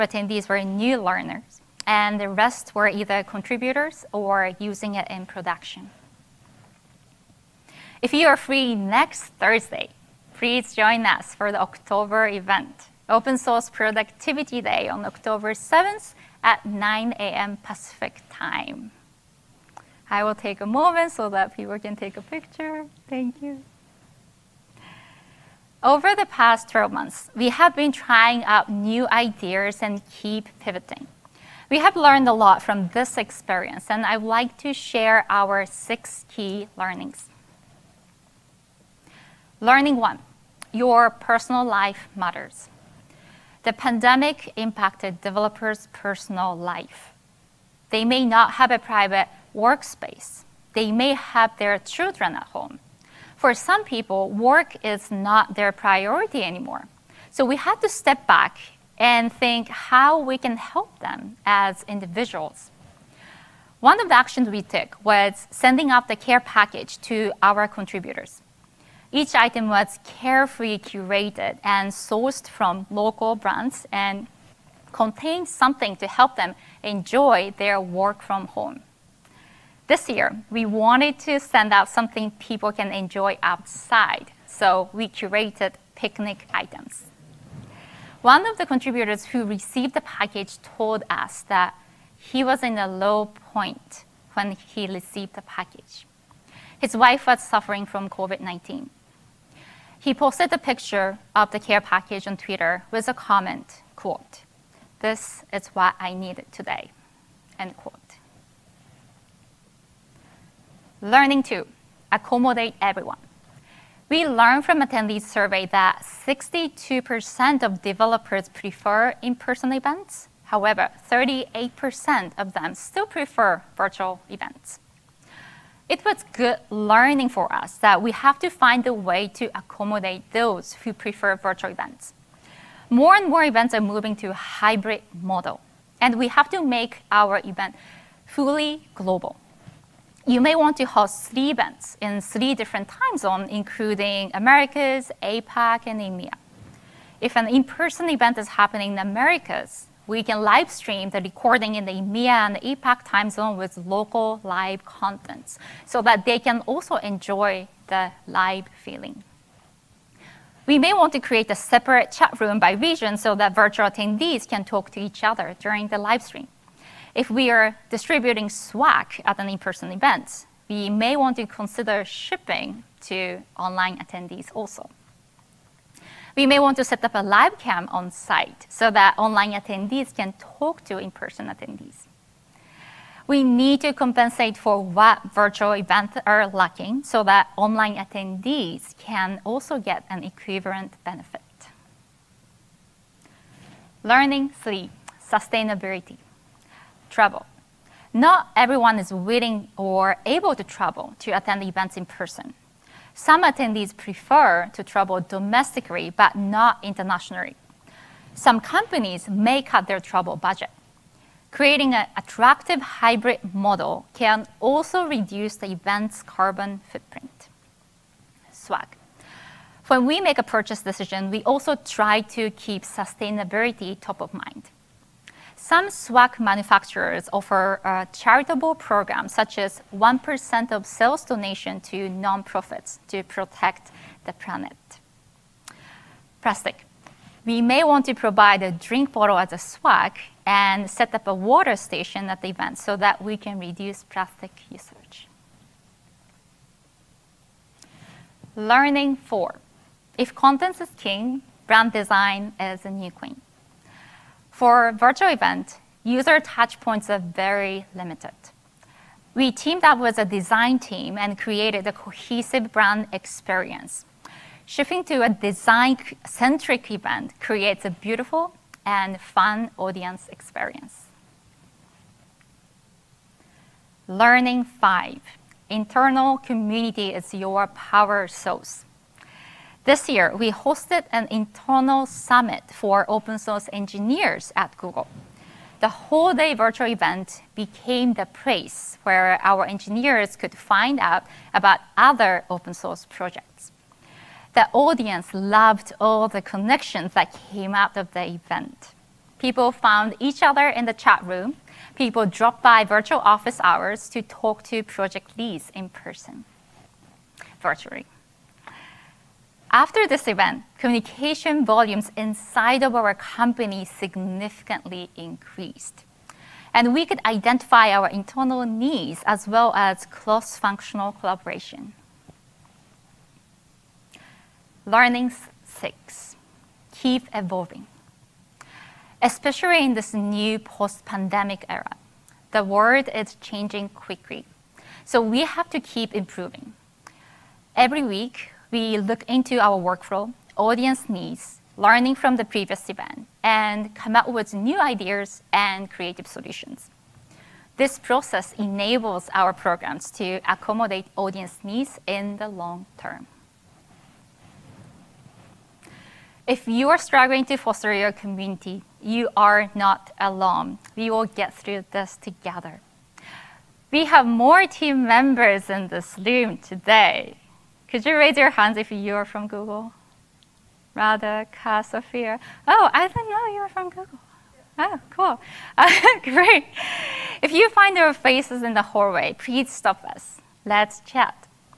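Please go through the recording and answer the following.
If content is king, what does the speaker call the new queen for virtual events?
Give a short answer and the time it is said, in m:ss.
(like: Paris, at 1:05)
brand design, at 4:11.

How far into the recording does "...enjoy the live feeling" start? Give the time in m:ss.
2:36.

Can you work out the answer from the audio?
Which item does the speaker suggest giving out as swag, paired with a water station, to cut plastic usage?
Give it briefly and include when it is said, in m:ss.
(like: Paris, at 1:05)
drink bottle, at 3:58.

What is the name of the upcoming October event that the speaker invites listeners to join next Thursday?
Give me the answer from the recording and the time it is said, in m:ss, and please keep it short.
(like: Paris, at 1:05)
Open Source Productivity Day, at 0:13.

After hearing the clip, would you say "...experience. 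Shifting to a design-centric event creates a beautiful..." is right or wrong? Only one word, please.
right.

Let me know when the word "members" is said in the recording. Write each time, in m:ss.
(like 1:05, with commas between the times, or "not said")
6:05.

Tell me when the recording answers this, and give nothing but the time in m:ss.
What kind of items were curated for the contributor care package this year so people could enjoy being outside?
1:25.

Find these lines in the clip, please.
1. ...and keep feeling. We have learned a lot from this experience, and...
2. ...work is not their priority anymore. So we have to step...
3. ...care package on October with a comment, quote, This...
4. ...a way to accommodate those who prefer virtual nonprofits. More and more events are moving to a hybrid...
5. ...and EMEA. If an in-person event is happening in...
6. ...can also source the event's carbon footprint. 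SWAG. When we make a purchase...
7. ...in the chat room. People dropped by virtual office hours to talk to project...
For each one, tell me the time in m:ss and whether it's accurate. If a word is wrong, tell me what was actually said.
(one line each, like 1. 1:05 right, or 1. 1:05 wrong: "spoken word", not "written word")
1. 0:29 wrong: "pivoting", not "feeling"
2. 0:54 right
3. 1:41 wrong: "Twitter", not "October"
4. 2:08 wrong: "events", not "nonprofits"
5. 2:25 right
6. 3:34 wrong: "reduce", not "source"
7. 5:00 right.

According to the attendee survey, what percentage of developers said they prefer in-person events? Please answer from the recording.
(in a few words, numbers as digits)
62%.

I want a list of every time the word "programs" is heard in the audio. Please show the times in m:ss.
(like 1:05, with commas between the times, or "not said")
3:48, 5:49.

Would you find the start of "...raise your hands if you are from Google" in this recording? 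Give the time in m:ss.
6:08.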